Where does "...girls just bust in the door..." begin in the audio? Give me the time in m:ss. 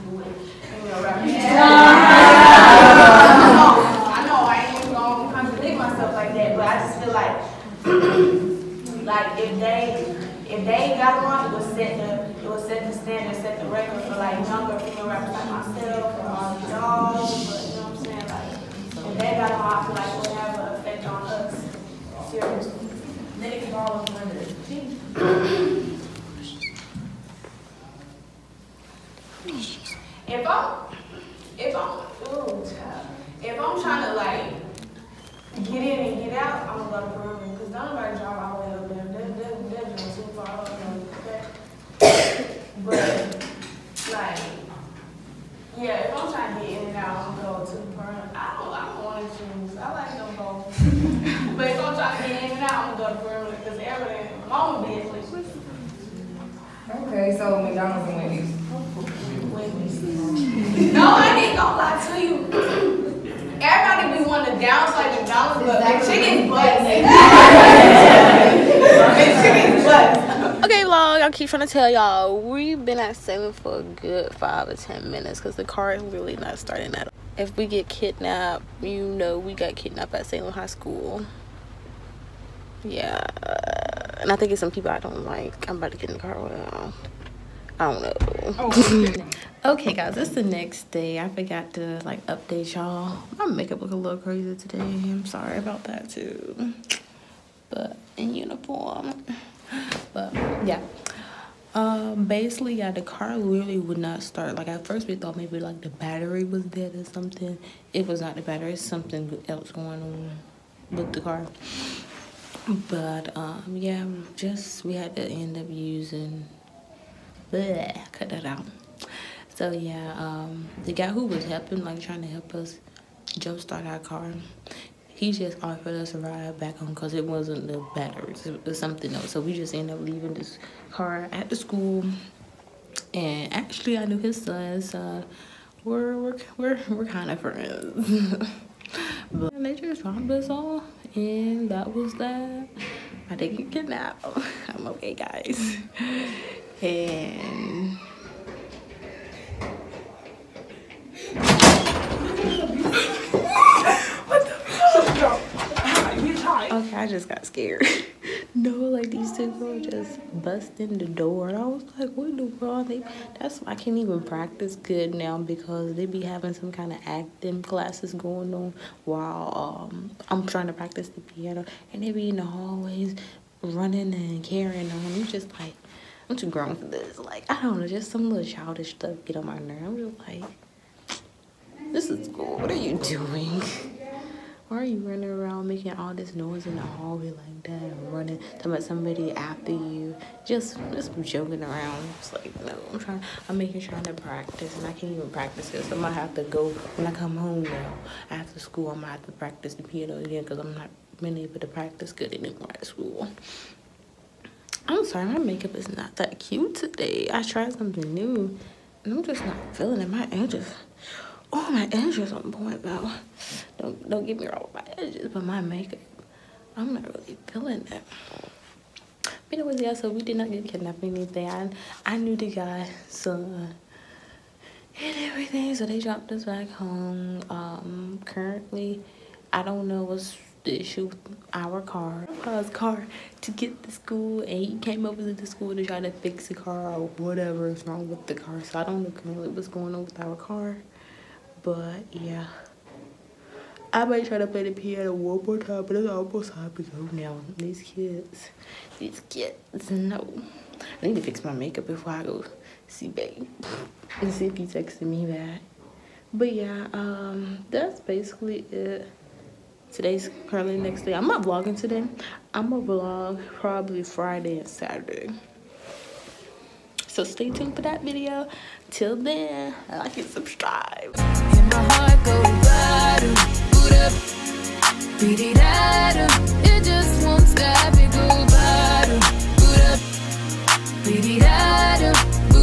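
2:39.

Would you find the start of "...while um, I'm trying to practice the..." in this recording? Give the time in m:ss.
2:49.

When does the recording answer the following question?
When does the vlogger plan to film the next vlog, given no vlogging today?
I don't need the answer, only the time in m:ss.
4:24.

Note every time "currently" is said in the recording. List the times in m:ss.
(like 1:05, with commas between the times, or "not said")
3:48, 4:20.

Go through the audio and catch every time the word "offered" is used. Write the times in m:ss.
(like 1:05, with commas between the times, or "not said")
2:05.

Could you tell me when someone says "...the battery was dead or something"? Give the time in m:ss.
1:45.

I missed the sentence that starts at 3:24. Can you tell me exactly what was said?
I'm sorry, my makeup is not that cute today.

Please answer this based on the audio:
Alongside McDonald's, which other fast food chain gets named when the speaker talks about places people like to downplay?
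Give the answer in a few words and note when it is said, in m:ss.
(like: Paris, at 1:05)
Wendy's, at 0:58.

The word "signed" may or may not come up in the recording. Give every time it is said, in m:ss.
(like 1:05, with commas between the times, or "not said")
not said.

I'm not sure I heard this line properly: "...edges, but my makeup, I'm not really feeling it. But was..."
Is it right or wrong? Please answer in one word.
right.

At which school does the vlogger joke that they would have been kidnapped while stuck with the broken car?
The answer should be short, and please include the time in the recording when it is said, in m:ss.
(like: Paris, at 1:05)
Salem High School, at 1:20.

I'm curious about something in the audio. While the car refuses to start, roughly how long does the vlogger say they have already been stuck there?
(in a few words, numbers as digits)
5 or 10 minutes.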